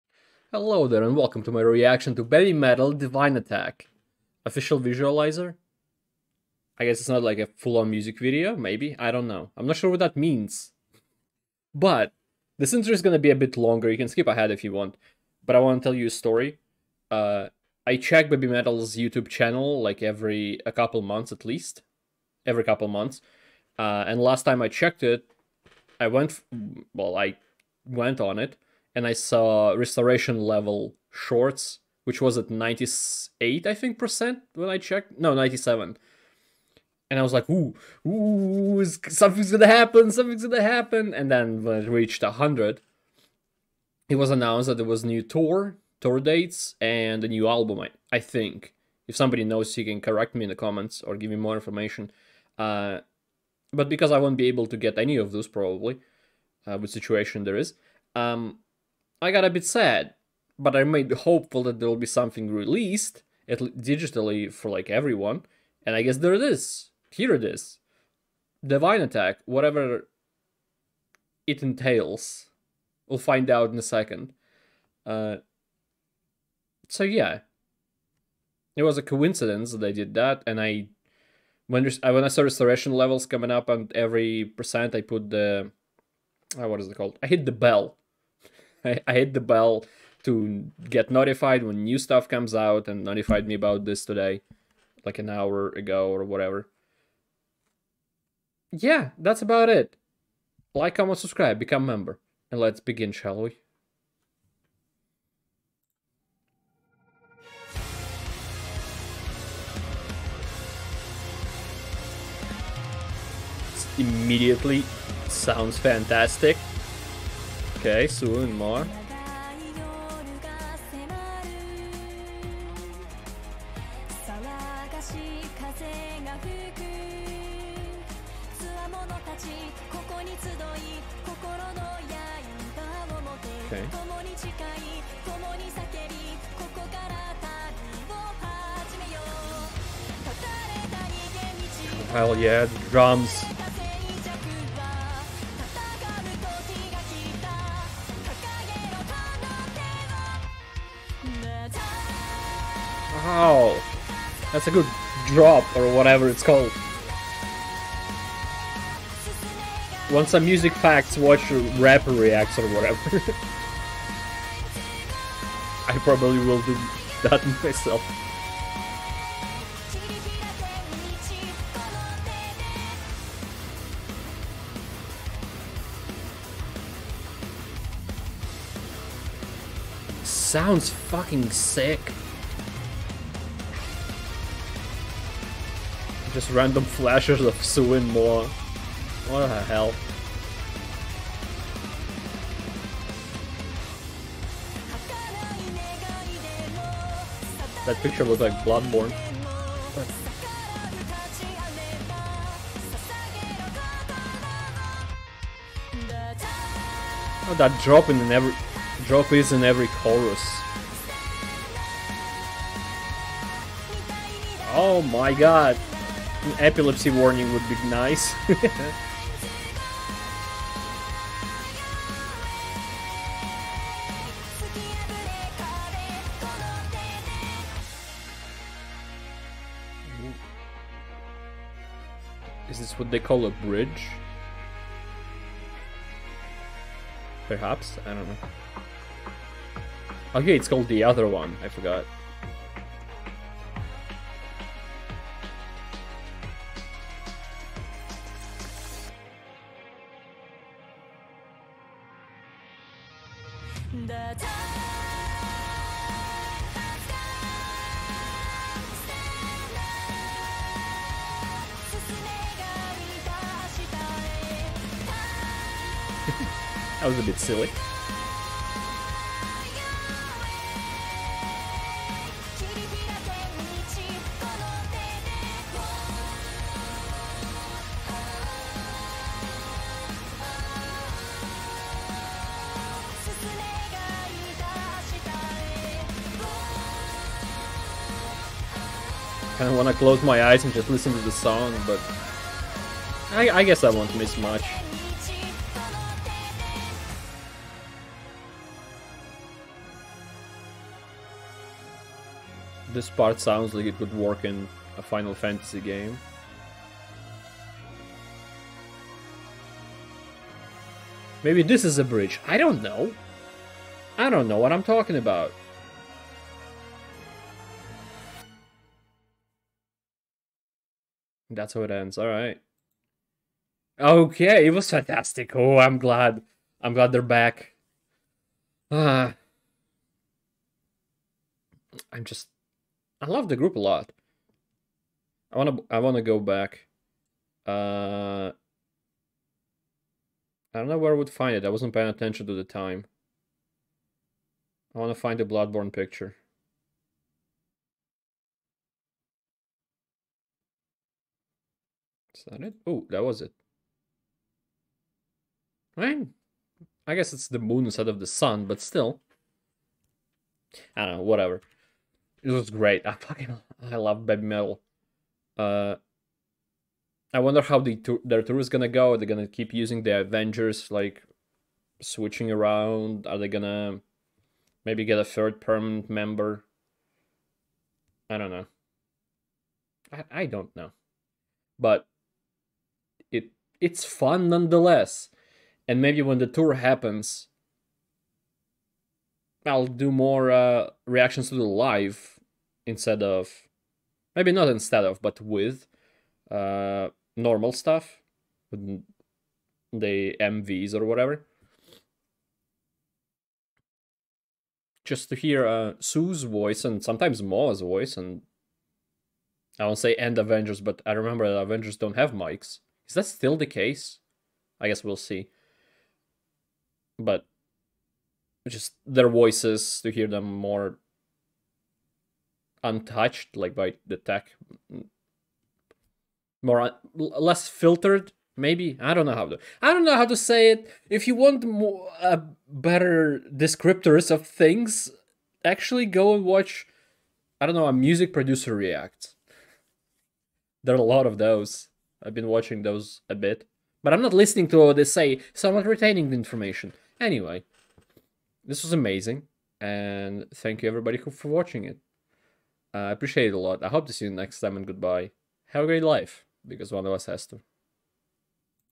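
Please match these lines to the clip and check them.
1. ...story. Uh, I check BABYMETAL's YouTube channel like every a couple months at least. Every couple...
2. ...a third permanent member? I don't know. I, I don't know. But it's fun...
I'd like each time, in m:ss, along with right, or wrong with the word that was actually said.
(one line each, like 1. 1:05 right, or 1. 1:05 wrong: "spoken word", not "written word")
1. 0:16 right
2. 6:15 right.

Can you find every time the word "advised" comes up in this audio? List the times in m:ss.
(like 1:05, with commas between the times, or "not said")
not said.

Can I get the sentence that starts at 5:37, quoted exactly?
Uh I don't know where I would find it.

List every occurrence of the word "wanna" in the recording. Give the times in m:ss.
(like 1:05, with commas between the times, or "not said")
0:15.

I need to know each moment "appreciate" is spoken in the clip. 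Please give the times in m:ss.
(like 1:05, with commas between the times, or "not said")
7:33.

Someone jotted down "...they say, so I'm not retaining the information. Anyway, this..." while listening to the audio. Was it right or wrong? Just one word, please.
right.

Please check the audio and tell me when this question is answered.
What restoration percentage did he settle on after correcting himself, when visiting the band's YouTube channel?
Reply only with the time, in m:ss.
0:35.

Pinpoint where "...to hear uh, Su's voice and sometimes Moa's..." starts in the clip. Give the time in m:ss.
6:45.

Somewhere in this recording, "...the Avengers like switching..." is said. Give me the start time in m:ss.
6:10.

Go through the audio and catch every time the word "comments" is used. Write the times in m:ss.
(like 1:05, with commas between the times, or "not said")
0:50, 1:40.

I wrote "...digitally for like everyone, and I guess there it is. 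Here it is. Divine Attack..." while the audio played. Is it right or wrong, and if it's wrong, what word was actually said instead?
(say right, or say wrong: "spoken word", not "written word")
right.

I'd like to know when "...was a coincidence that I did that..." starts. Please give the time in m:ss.
1:18.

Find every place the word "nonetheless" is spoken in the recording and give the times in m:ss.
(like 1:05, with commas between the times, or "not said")
6:24.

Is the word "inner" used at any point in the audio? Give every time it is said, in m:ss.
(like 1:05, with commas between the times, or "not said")
not said.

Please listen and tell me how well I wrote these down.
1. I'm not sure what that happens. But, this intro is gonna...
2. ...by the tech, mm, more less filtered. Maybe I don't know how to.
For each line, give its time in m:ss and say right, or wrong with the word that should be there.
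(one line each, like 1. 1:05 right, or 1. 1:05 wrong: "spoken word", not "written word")
1. 0:09 wrong: "means", not "happens"
2. 7:03 right.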